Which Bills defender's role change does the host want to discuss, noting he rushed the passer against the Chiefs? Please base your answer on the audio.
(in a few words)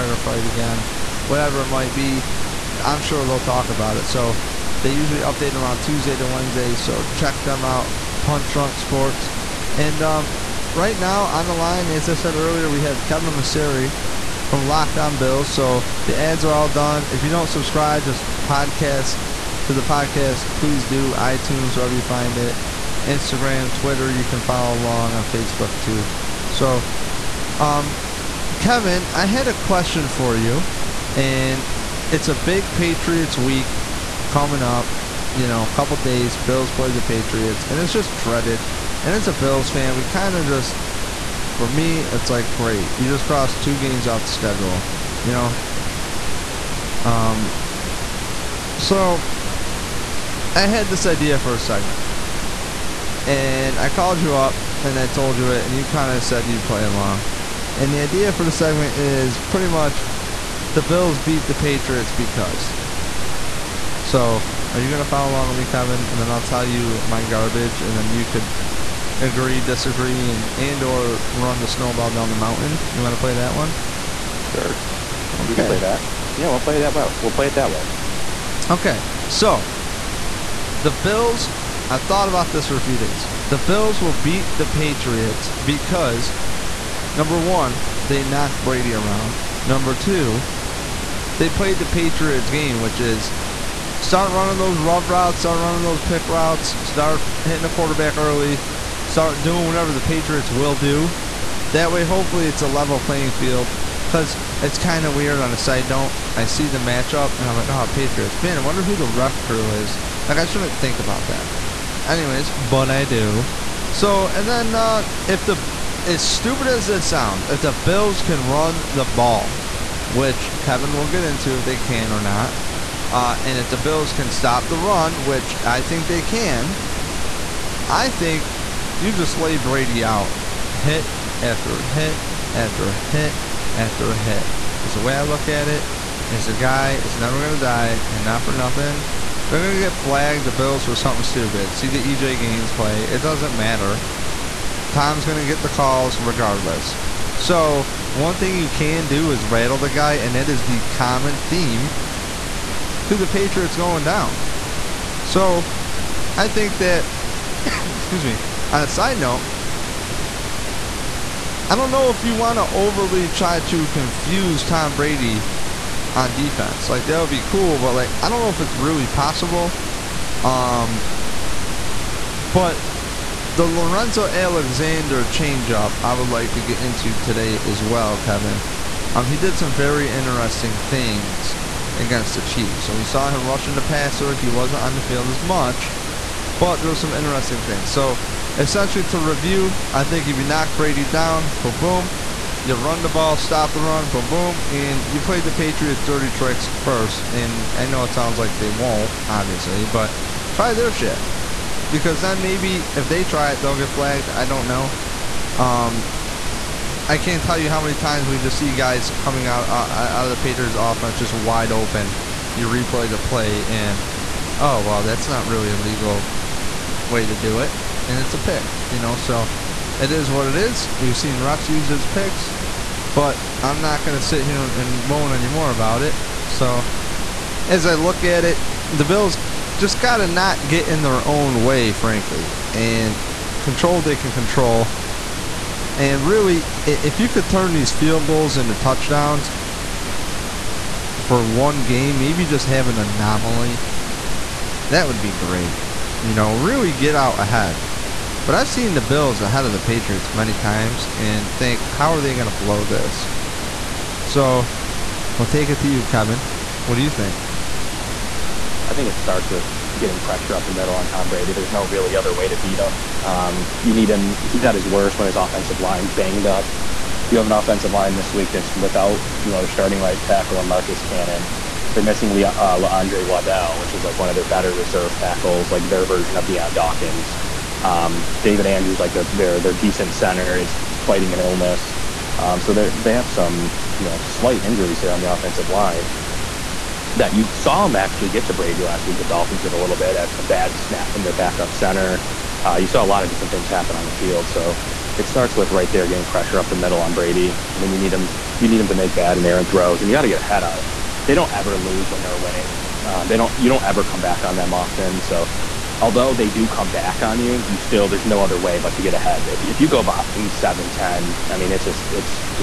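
Lorenzo Alexander.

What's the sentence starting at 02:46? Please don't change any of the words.
Like that would be cool, but like I don't know if it's really possible.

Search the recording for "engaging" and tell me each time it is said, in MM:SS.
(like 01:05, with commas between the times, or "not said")
not said.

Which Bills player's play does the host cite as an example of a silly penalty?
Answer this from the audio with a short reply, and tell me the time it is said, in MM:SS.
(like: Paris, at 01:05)
EJ Gaines, at 02:22.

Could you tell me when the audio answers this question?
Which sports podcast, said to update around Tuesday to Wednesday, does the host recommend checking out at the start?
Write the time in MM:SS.
00:08.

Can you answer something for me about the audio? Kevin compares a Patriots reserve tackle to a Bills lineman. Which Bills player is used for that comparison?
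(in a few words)
Dion Dawkins.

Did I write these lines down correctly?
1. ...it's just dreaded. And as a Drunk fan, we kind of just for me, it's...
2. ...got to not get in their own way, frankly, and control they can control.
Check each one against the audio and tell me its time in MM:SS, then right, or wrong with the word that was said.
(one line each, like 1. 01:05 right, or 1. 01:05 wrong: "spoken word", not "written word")
1. 00:37 wrong: "Bills", not "Drunk"
2. 03:49 right.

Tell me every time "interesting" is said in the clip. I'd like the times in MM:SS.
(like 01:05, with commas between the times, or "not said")
03:00, 03:07.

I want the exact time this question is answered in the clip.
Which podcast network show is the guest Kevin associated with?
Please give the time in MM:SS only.
00:14.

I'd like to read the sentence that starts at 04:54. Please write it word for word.
So it starts with right there getting pressure up the middle on Brady.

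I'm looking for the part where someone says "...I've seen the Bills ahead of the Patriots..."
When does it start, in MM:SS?
04:08.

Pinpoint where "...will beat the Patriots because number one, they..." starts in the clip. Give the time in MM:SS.
01:24.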